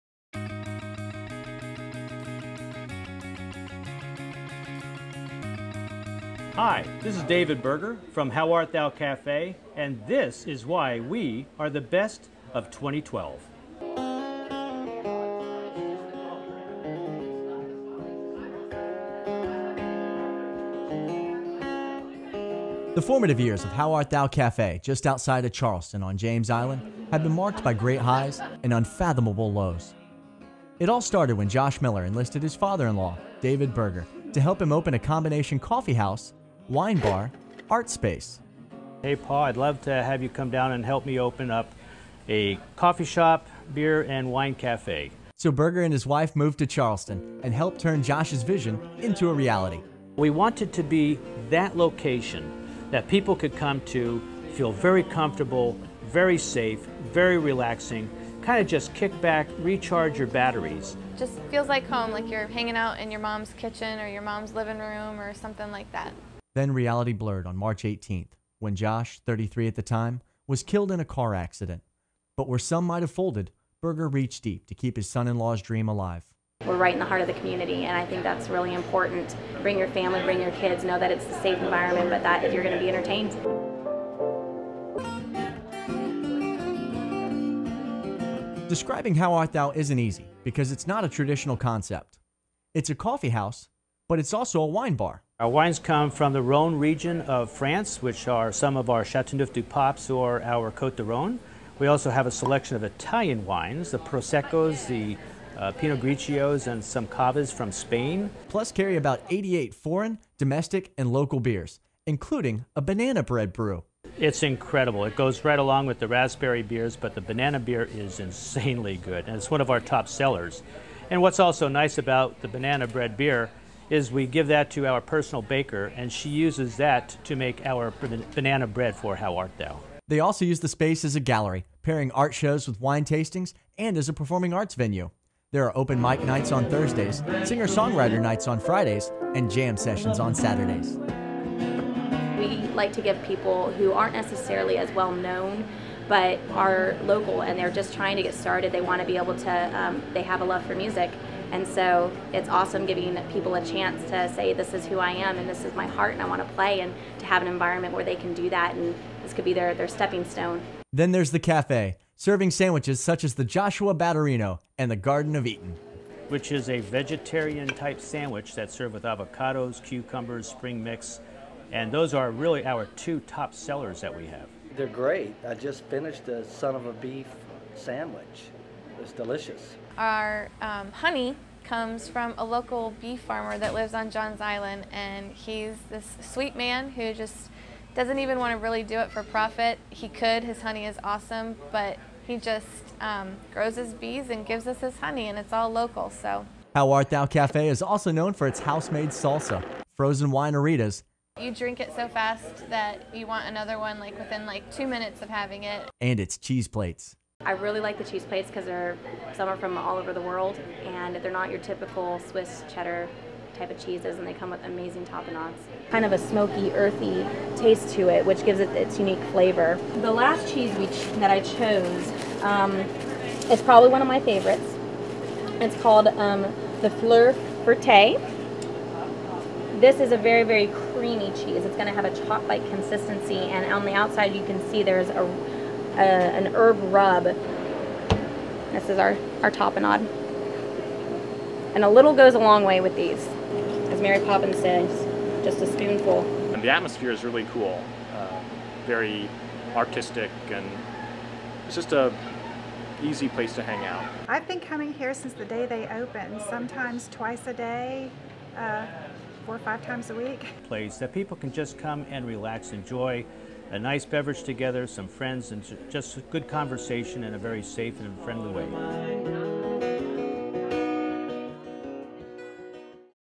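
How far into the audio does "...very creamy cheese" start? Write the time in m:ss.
3:50.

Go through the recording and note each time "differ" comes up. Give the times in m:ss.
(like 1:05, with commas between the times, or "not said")
not said.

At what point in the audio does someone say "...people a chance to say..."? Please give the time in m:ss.
2:33.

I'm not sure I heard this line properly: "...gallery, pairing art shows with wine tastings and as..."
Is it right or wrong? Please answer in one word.
right.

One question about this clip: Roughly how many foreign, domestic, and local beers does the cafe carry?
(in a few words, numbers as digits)
88.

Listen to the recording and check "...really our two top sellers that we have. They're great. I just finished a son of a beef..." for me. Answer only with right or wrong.
right.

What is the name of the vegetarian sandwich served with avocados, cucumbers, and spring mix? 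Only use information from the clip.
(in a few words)
Garden of Eden.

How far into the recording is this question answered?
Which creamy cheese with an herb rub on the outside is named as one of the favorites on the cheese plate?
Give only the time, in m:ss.
3:46.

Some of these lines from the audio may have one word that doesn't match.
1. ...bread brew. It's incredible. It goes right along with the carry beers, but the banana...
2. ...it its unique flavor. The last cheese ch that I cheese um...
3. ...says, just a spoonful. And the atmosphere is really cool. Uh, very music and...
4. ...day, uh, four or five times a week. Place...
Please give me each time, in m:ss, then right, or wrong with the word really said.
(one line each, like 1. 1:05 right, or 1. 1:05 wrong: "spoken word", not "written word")
1. 1:53 wrong: "raspberry", not "carry"
2. 3:38 wrong: "chose", not "cheese"
3. 4:04 wrong: "artistic", not "music"
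4. 4:17 right.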